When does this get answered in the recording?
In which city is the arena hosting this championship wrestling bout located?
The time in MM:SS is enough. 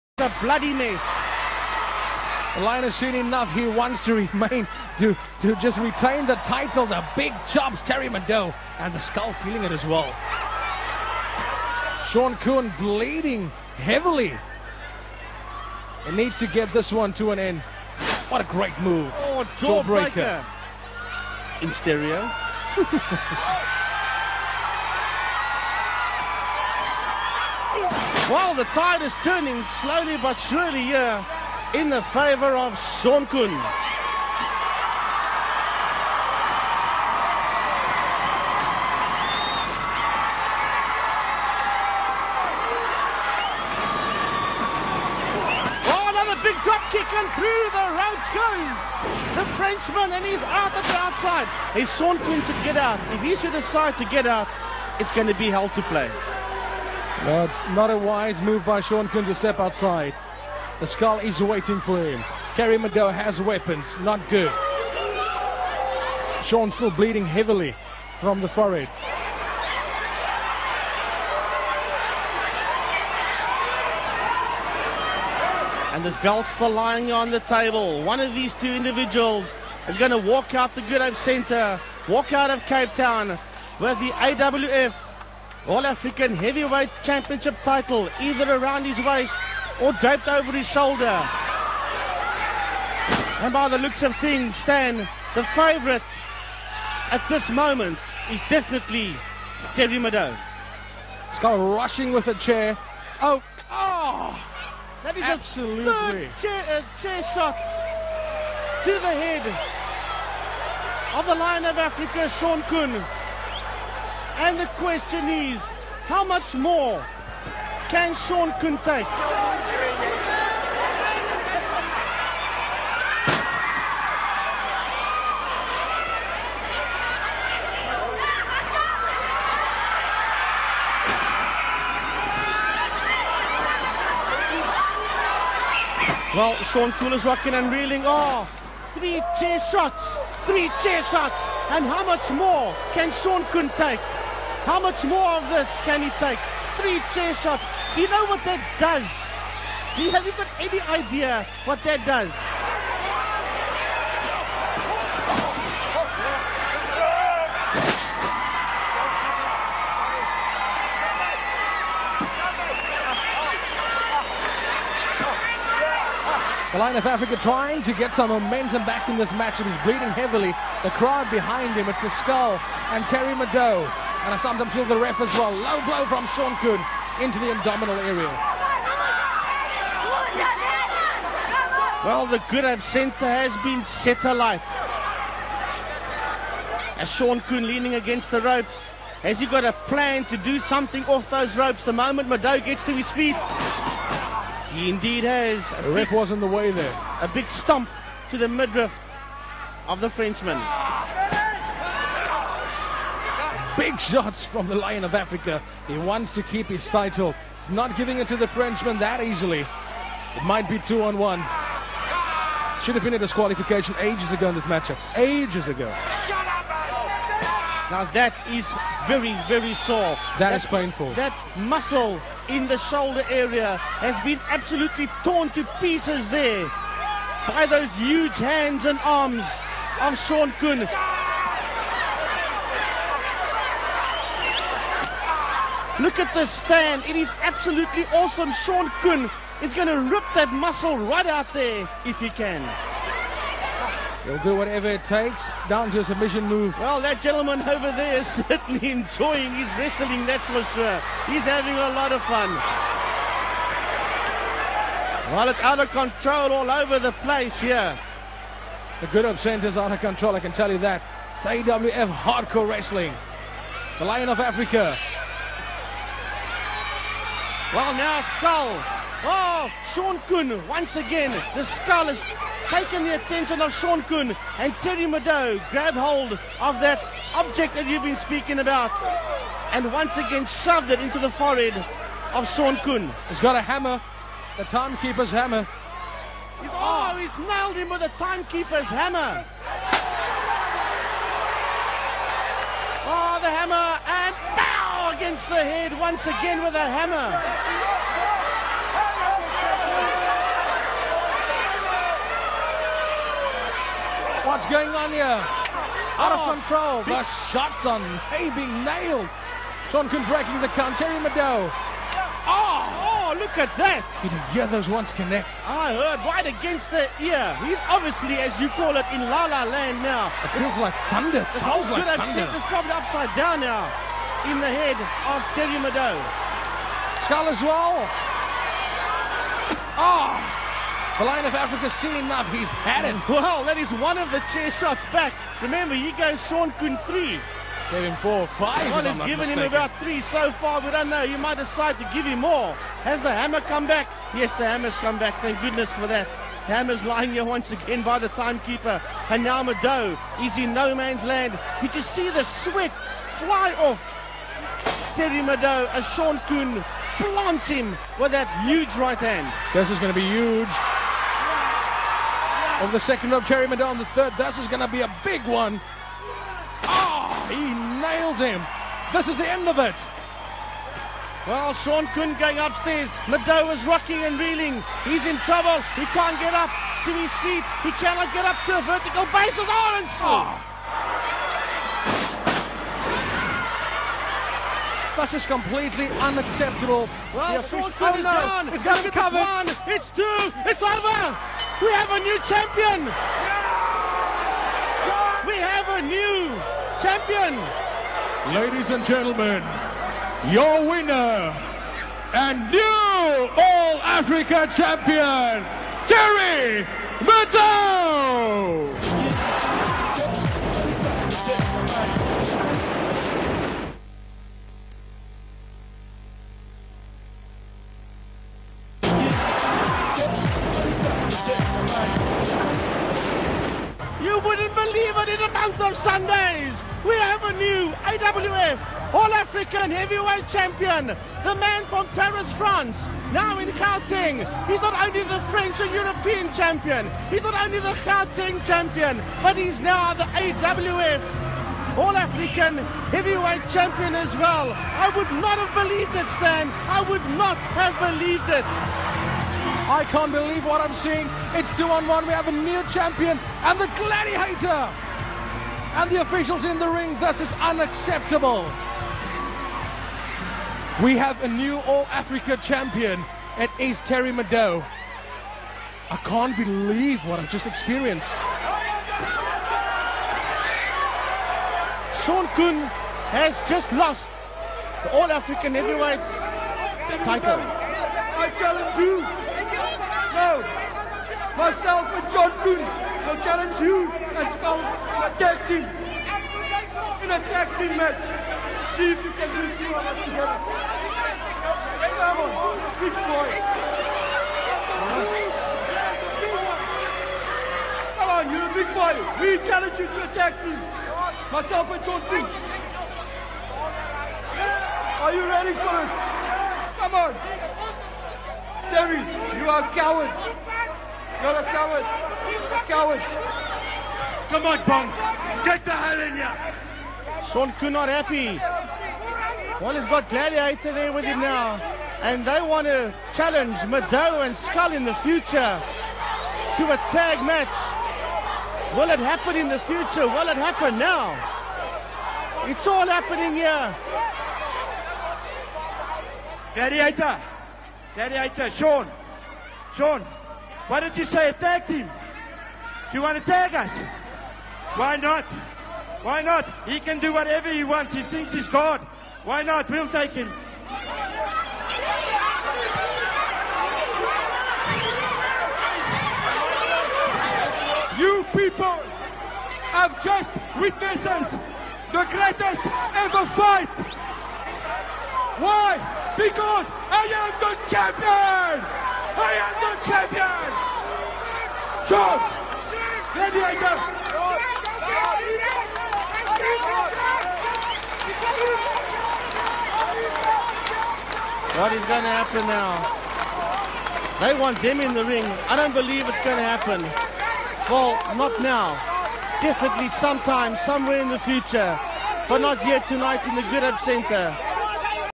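01:22.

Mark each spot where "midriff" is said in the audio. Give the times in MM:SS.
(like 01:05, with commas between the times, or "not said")
03:18.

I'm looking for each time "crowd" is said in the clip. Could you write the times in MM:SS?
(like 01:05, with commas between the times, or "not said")
02:51.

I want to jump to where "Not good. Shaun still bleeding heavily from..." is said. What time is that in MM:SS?
01:03.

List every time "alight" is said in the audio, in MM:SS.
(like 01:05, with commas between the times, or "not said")
03:04.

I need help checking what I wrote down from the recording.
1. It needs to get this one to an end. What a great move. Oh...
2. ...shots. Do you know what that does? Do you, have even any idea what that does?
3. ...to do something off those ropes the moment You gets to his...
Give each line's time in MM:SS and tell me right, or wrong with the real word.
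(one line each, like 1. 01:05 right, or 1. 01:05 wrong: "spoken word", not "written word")
1. 00:16 right
2. 02:27 right
3. 03:10 wrong: "Middoux", not "You".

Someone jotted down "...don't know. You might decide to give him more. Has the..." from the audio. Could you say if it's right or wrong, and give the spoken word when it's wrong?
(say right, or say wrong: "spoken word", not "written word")
right.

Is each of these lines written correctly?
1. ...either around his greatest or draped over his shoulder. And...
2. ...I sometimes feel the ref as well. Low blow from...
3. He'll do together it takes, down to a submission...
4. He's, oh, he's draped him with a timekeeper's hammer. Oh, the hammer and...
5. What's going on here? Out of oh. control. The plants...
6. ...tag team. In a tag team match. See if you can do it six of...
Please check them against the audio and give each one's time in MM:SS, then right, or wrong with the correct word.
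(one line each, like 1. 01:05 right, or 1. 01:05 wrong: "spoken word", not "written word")
1. 01:28 wrong: "waist", not "greatest"
2. 02:54 right
3. 04:04 wrong: "whatever", not "together"
4. 04:46 wrong: "nailed", not "draped"
5. 05:04 wrong: "shots", not "plants"
6. 08:05 wrong: "two", not "six".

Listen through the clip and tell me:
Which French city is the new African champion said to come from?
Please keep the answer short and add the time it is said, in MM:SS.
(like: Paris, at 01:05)
Paris, at 07:12.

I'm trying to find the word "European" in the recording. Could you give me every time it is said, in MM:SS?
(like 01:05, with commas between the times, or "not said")
07:15.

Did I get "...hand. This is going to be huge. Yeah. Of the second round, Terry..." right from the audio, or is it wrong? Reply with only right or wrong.
right.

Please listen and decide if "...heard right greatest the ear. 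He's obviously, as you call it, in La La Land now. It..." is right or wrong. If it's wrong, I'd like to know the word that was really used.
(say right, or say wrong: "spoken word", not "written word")
wrong: "against", not "greatest".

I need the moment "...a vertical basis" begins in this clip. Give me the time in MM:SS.
06:18.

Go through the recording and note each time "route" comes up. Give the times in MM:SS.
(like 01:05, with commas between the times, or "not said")
00:47.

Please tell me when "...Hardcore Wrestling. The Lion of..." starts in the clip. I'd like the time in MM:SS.
04:22.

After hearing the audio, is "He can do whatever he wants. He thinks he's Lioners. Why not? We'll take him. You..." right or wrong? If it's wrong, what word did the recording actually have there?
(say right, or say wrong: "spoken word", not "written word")
wrong: "God", not "Lioners".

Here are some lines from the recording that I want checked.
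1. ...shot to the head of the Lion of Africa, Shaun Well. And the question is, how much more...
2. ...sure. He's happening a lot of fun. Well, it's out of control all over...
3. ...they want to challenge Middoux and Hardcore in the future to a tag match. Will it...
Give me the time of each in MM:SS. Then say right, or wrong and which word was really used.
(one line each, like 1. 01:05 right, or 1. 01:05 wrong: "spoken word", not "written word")
1. 01:47 wrong: "Koen", not "Well"
2. 04:10 wrong: "having", not "happening"
3. 08:42 wrong: "Skull", not "Hardcore".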